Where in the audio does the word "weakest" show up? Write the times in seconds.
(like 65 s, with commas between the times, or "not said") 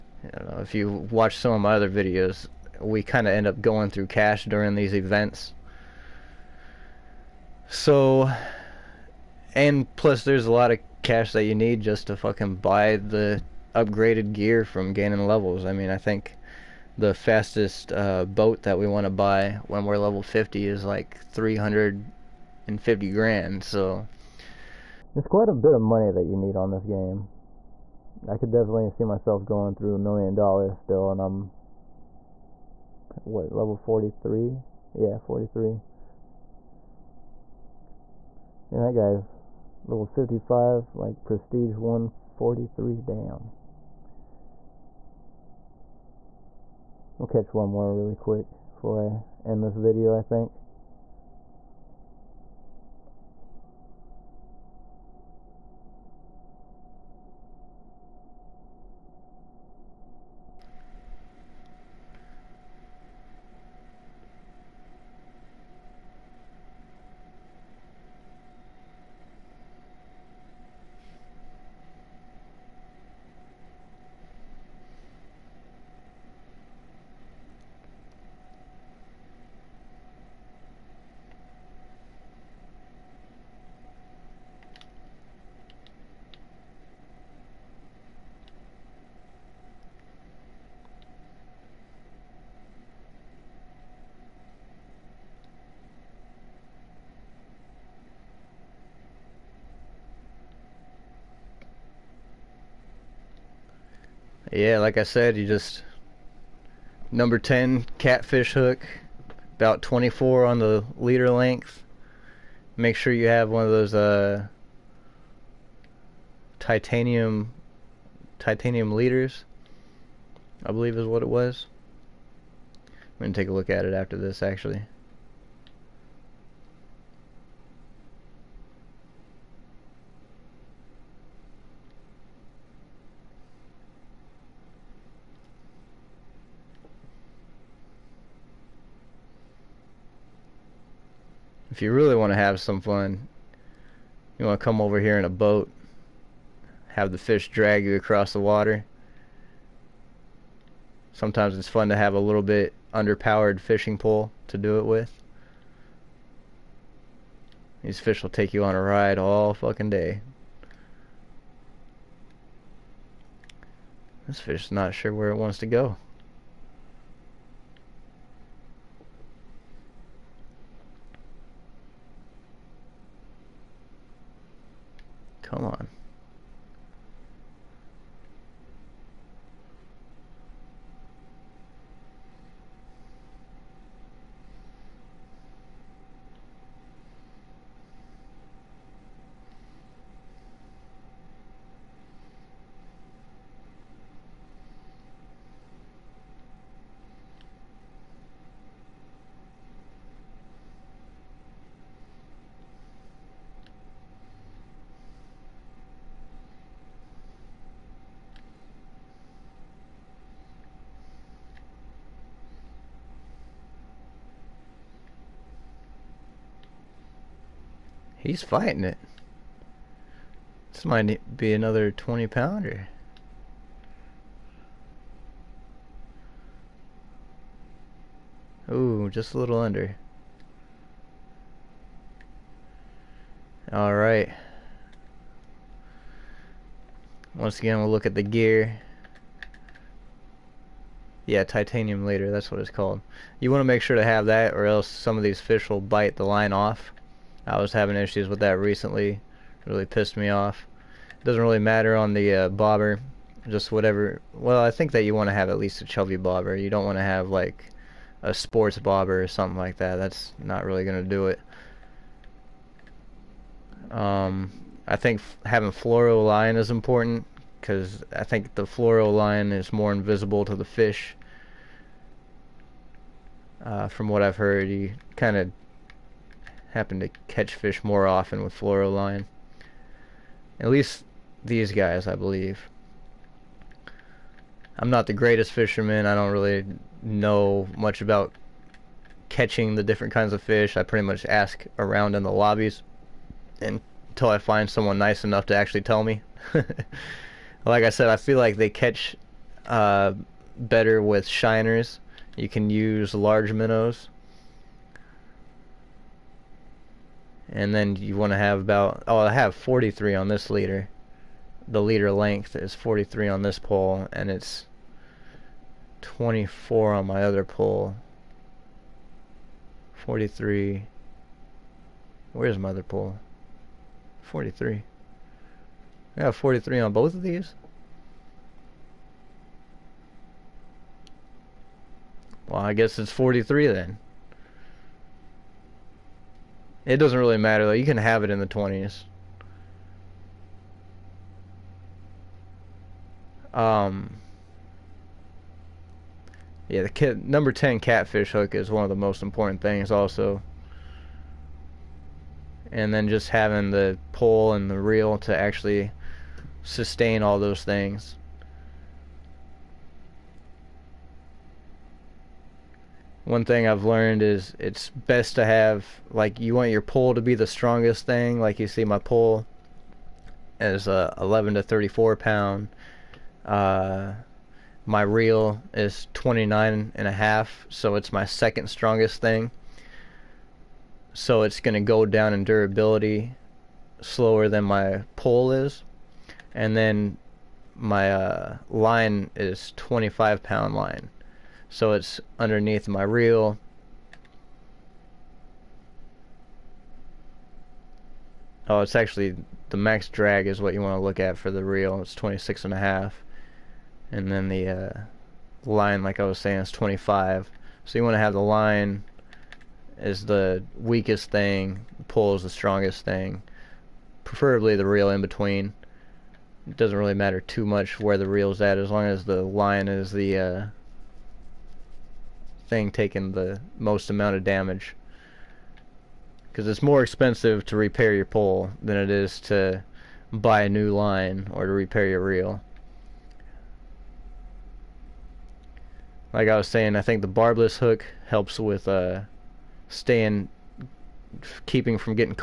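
410 s.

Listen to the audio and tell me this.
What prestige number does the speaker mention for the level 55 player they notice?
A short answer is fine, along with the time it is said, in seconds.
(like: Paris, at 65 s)
143, at 41 s.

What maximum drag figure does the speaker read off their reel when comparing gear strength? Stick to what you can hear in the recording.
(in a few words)
26.5.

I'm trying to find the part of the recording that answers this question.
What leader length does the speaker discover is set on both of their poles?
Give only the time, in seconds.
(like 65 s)
326 s.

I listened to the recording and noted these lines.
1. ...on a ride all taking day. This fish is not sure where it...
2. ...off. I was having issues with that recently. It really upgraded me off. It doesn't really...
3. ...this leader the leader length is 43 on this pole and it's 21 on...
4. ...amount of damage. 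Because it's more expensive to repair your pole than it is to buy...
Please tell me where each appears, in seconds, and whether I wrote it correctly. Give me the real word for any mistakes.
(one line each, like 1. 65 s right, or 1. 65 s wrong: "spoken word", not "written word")
1. 158 s wrong: "fucking", not "taking"
2. 246 s wrong: "pissed", not "upgraded"
3. 310 s wrong: "24", not "21"
4. 424 s right.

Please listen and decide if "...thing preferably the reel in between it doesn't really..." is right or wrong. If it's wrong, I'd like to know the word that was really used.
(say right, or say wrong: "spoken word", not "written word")
right.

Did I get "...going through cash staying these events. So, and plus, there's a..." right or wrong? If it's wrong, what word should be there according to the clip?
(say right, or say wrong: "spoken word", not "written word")
wrong: "during", not "staying".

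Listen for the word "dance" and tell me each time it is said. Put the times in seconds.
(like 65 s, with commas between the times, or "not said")
not said.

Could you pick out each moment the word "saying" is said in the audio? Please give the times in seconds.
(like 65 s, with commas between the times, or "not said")
406 s, 436 s.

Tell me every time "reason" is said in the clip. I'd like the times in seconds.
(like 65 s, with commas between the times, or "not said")
not said.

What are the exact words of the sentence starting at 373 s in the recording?
Uh, my reel is 29 and a half, so it's my second strongest thing.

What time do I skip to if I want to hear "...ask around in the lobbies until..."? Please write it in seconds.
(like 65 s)
291 s.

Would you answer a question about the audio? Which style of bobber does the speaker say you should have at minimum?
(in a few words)
chubby bobber.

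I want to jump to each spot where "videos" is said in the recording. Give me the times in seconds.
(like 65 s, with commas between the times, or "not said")
1 s, 49 s.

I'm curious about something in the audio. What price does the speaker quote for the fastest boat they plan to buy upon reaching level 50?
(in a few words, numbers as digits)
350 grand.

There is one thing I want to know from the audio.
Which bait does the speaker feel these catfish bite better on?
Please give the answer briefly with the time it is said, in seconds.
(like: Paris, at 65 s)
shiners, at 301 s.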